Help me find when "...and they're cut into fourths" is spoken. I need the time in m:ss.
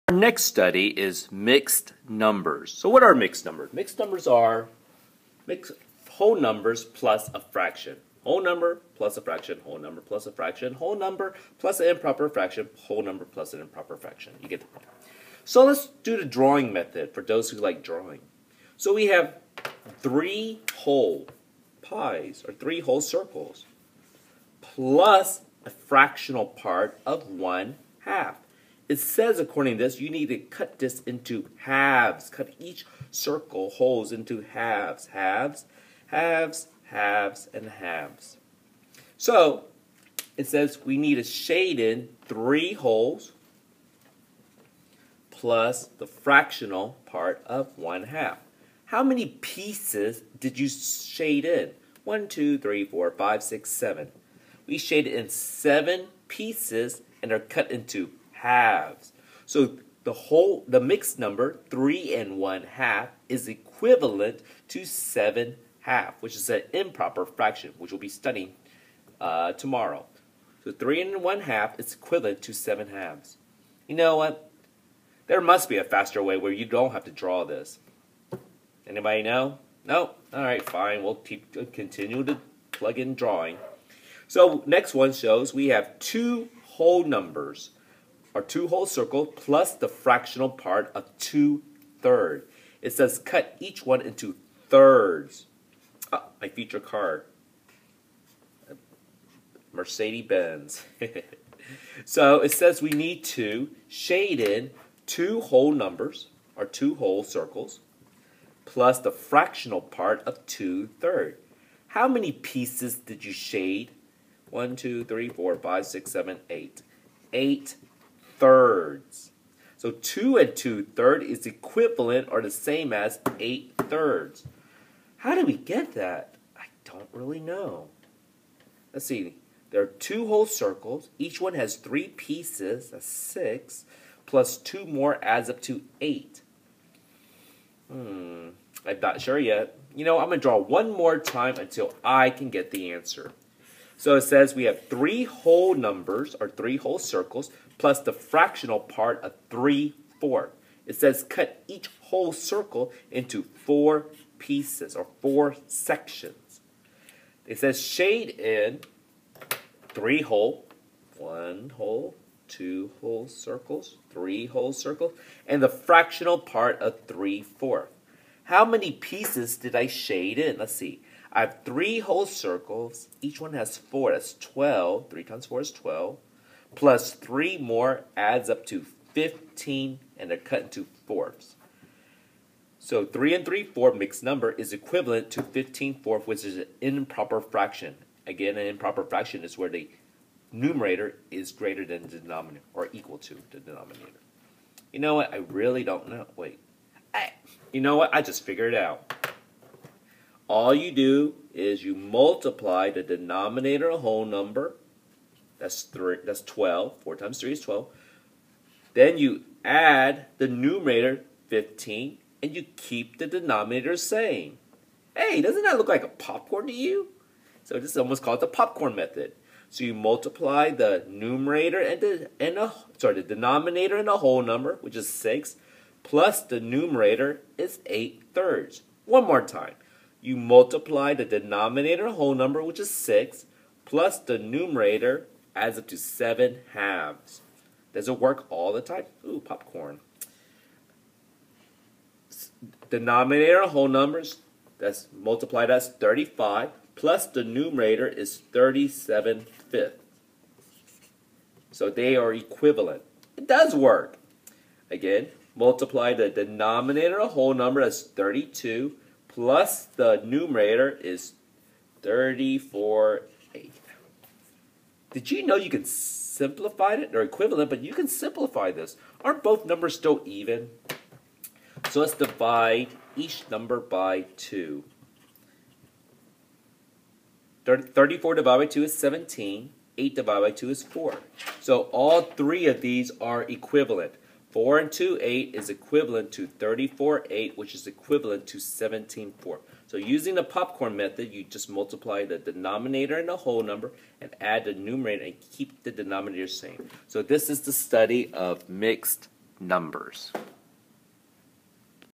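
3:00.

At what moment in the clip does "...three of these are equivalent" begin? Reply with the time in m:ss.
4:42.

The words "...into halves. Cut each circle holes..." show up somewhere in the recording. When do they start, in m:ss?
0:31.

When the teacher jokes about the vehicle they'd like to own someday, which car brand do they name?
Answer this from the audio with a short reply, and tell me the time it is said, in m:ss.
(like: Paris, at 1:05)
Mercedes-Benz, at 1:39.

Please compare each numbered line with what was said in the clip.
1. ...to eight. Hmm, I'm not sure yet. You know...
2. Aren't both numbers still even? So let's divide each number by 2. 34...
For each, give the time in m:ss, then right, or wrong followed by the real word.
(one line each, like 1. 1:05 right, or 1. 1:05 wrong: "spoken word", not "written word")
1. 2:15 right
2. 4:29 right.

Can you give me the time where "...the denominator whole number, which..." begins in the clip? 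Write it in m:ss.
3:51.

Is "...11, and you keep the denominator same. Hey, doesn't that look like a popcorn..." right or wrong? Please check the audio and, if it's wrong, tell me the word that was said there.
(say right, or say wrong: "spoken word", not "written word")
wrong: "15", not "11".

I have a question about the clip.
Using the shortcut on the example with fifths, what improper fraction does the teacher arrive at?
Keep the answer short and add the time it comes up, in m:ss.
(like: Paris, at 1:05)
37 fifths, at 4:08.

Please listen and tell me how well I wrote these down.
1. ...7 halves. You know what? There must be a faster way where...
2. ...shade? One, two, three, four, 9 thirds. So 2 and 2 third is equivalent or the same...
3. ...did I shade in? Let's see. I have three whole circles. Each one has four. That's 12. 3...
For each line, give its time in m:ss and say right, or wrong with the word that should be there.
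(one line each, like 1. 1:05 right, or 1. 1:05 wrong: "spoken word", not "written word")
1. 1:12 right
2. 1:53 wrong: "8", not "9"
3. 2:49 right.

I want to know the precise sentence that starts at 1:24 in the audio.
So next one shows we have two whole numbers our two whole circle plus the fractional part of two thirds.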